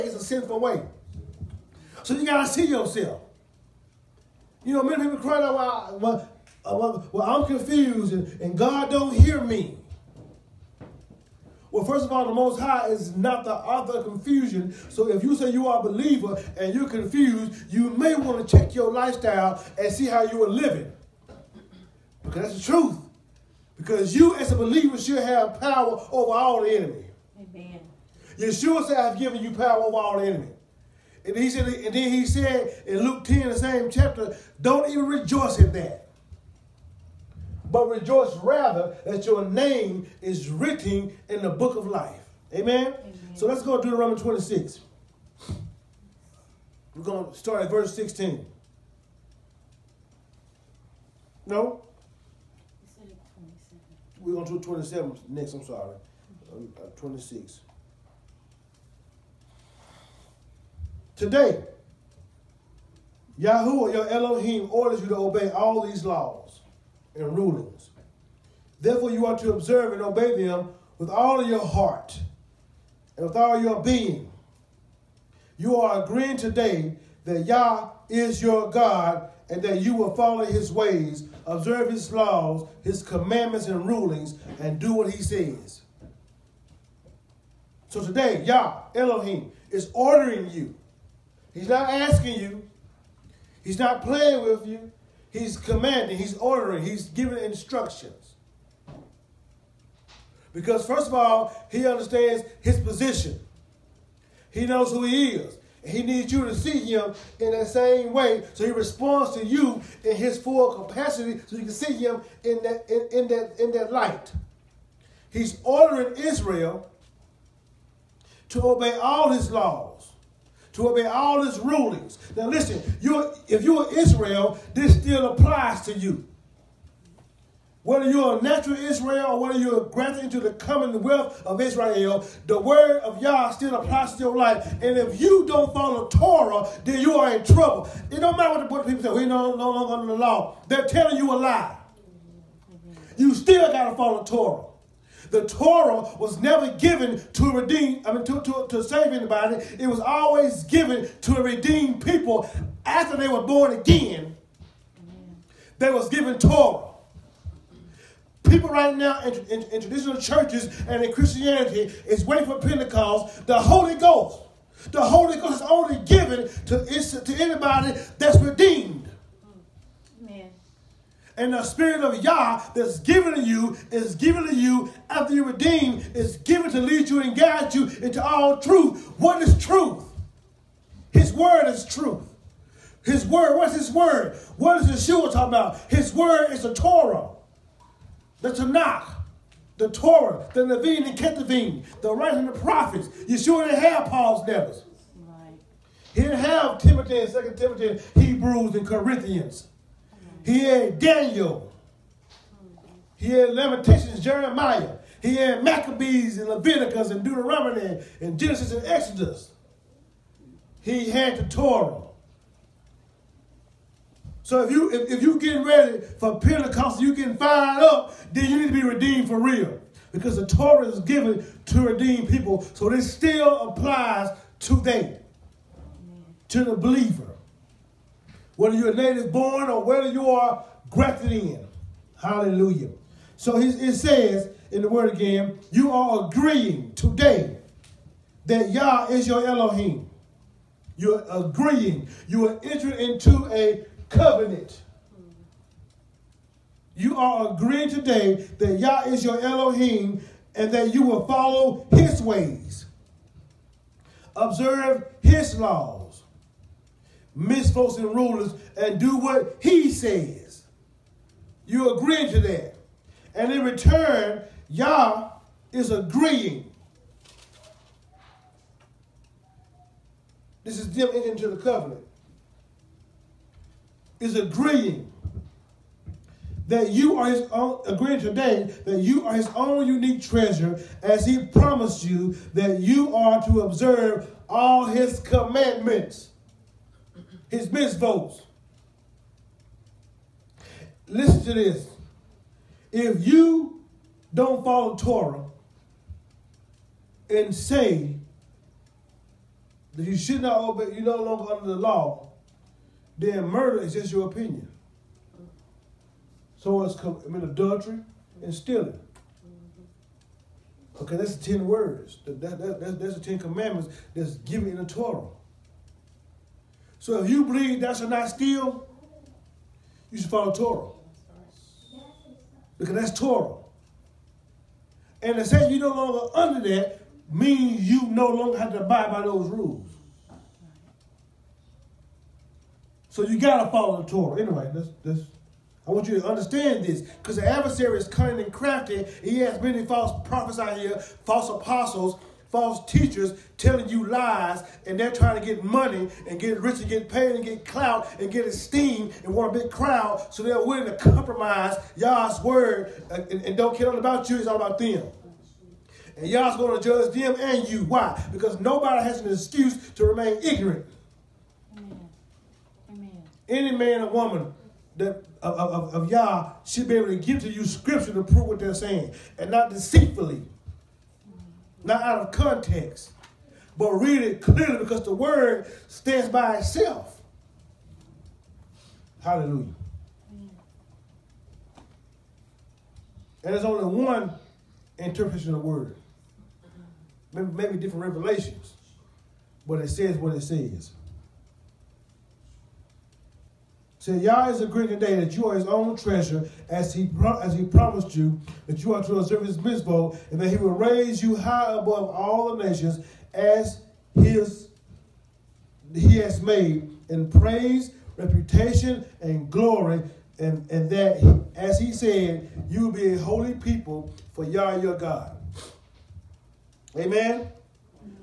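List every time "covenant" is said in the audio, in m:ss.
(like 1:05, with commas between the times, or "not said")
4:04, 4:31.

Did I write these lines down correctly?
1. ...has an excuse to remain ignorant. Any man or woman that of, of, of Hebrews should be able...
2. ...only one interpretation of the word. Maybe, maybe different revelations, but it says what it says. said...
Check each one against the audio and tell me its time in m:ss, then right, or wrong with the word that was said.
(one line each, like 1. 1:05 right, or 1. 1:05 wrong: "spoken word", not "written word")
1. 5:59 wrong: "Yah", not "Hebrews"
2. 6:23 right.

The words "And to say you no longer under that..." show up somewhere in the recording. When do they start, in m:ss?
5:25.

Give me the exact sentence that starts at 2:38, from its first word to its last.
People right now in, in, in traditional churches and in Christianity is waiting for Pentecost, the Holy Ghost.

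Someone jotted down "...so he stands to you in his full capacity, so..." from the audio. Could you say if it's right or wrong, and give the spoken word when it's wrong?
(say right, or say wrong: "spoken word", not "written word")
wrong: "responds", not "stands".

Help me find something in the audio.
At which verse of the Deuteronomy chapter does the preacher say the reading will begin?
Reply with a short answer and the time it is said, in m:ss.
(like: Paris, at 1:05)
16, at 0:47.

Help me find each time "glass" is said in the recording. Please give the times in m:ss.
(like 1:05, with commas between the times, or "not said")
not said.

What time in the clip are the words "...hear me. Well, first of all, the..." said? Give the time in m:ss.
0:09.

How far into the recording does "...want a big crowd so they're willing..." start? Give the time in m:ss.
5:49.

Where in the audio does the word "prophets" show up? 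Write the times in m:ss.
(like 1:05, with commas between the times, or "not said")
3:12, 5:40.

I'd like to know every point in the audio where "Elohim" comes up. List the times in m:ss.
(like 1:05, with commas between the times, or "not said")
1:04, 1:28, 3:59, 4:09.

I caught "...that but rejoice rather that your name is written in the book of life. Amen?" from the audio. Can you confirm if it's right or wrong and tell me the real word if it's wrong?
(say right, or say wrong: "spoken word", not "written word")
right.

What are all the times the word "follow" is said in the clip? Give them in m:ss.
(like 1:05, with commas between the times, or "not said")
1:20, 2:15, 2:23, 4:11, 4:54, 5:20, 5:33.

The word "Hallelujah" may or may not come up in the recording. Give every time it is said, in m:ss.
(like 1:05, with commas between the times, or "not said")
3:52, 6:19.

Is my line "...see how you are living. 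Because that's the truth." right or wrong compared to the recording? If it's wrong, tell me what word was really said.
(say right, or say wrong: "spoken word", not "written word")
right.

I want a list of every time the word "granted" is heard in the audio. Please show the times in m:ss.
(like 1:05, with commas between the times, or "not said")
2:09.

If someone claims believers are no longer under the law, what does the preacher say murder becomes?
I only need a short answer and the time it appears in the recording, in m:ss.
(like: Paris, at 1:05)
Just your opinion, at 5:03.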